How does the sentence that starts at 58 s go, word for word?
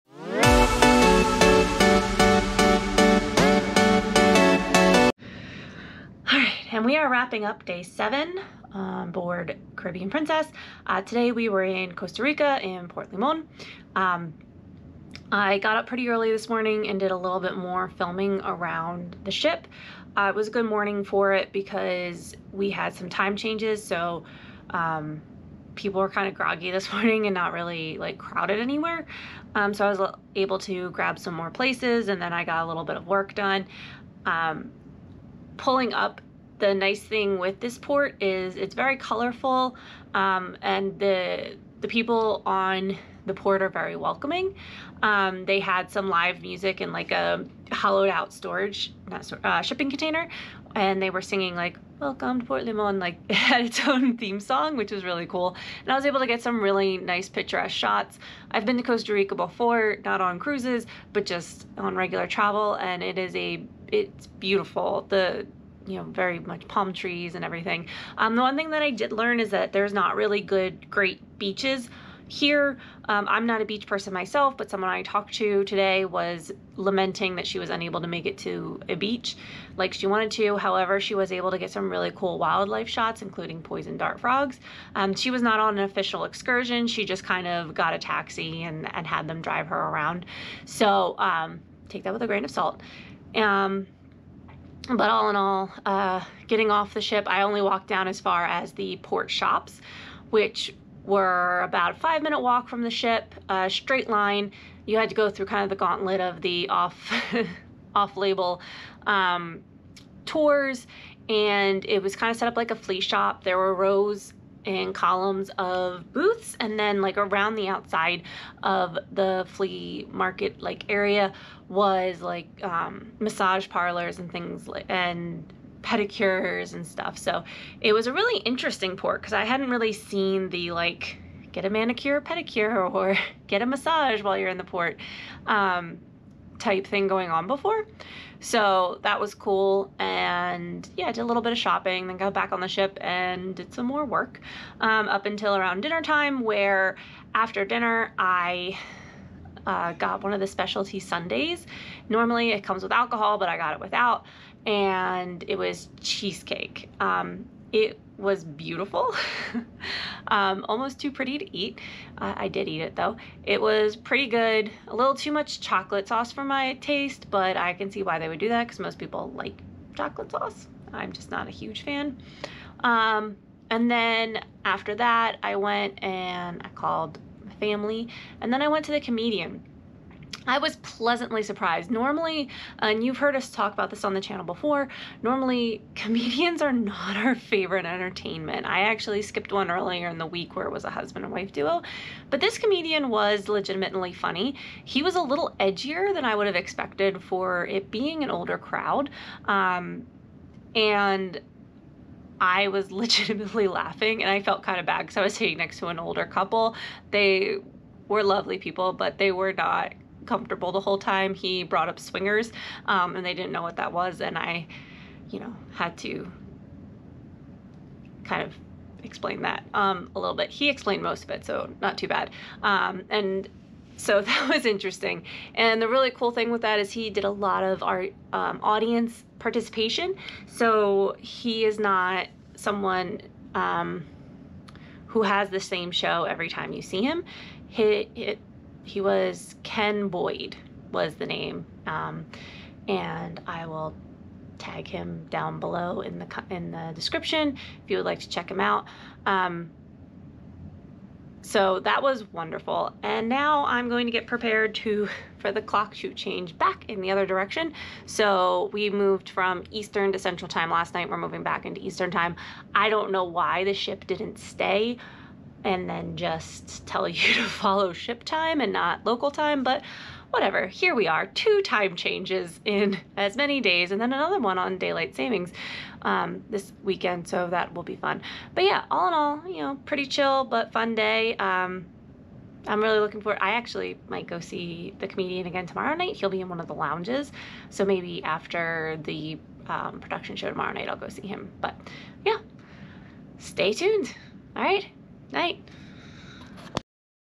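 I've been to Costa Rica before, not on cruises, but just on regular travel, and it is a it's beautiful.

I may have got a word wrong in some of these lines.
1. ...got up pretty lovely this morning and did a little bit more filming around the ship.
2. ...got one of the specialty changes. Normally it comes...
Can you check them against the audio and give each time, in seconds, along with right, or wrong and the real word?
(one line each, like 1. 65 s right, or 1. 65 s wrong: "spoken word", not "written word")
1. 15 s wrong: "early", not "lovely"
2. 149 s wrong: "sundaes", not "changes".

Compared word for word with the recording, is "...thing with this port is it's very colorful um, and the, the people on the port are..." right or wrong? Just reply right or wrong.
right.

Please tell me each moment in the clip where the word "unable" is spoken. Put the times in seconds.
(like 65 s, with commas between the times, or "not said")
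77 s.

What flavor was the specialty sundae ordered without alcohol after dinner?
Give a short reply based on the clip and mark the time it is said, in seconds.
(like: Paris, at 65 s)
cheesecake, at 155 s.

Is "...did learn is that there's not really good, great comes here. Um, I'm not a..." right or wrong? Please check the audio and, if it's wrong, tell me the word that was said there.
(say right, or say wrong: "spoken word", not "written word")
wrong: "beaches", not "comes".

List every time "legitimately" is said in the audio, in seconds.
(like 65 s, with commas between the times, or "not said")
193 s, 202 s.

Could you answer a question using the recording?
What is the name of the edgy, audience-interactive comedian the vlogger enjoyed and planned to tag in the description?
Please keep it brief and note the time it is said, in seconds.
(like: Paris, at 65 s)
Ken Boyd, at 239 s.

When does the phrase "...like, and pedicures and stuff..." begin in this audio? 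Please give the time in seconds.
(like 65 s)
124 s.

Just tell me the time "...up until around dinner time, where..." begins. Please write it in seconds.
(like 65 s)
145 s.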